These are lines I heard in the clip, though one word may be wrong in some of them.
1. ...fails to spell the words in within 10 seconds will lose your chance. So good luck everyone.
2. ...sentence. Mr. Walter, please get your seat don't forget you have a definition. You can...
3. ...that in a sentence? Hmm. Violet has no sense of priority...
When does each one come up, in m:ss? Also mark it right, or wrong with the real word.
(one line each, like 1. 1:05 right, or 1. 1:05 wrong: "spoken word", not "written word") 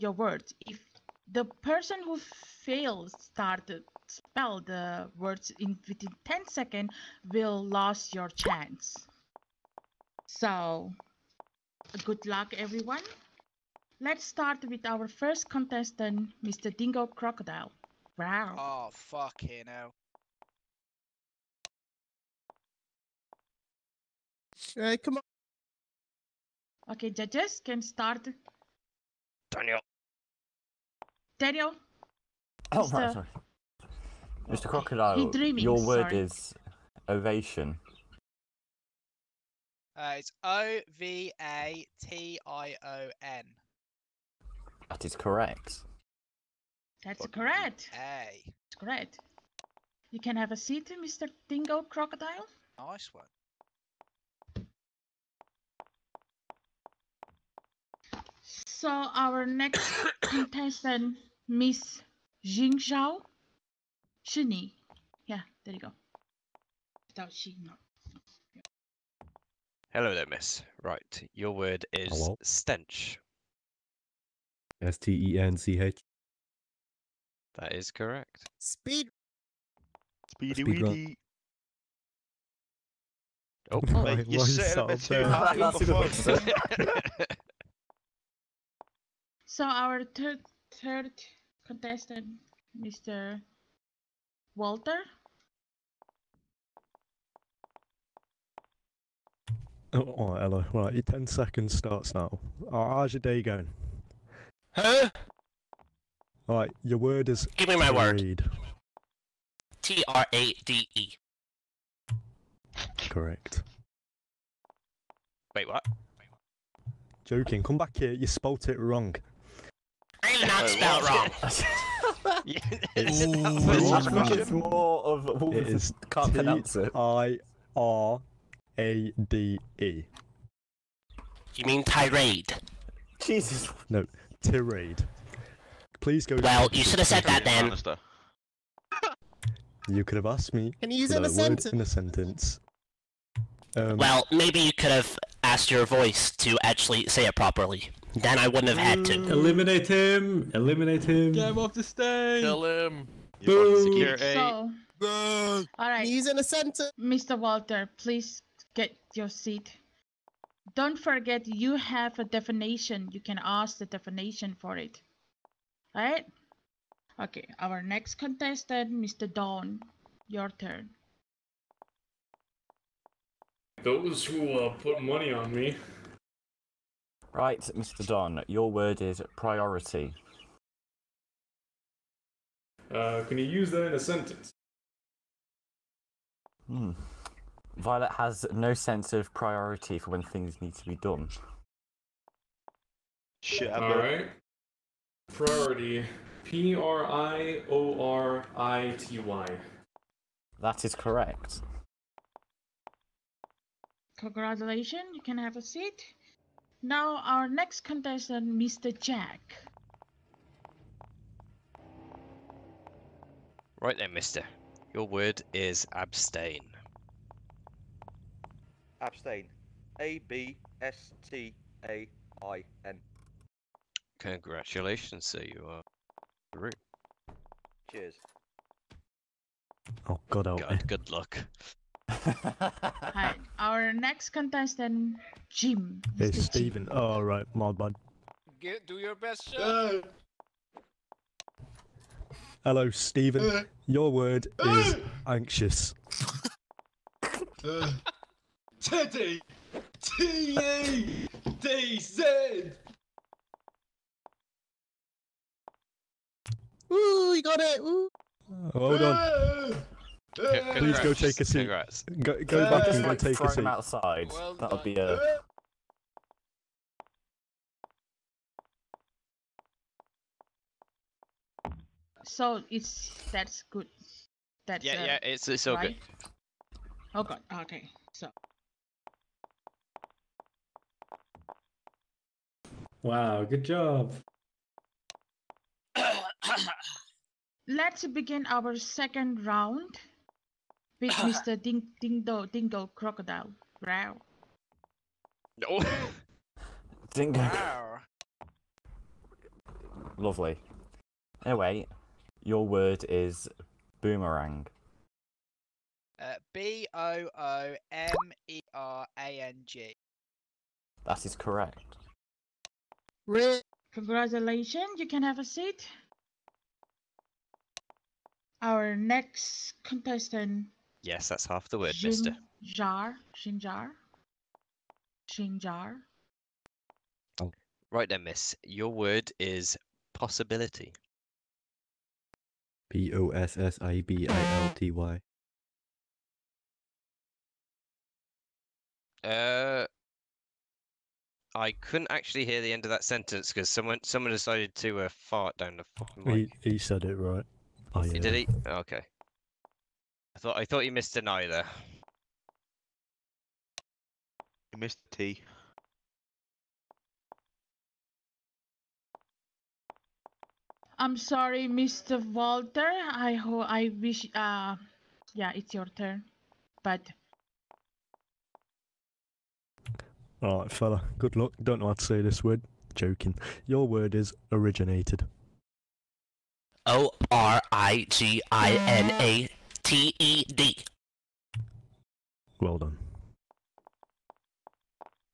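1. 0:02 right
2. 2:36 right
3. 3:03 right.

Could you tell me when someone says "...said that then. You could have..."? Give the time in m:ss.
2:17.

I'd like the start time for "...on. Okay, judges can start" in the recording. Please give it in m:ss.
0:25.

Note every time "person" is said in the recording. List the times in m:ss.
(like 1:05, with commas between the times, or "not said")
0:01.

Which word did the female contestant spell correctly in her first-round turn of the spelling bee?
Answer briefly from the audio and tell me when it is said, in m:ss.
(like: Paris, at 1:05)
stench, at 1:12.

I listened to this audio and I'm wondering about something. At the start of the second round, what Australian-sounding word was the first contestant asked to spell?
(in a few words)
boomerang.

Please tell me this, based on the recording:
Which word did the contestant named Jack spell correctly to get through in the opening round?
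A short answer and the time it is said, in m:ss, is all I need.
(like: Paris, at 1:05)
abstain, at 3:35.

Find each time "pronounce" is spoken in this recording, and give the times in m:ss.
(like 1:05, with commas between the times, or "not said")
2:06.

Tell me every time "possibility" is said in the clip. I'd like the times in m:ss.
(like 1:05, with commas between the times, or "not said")
5:30.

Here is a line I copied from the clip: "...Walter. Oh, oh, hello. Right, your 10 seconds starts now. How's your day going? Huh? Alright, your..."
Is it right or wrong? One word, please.
right.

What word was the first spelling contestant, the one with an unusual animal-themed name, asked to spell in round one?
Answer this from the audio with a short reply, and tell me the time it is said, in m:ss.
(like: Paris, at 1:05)
ovation, at 0:36.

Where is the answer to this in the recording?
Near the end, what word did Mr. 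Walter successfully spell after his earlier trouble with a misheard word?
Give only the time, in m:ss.
6:14.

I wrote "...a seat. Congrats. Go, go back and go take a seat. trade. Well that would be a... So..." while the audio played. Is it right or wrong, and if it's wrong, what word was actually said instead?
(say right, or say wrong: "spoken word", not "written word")
wrong: "outside", not "trade".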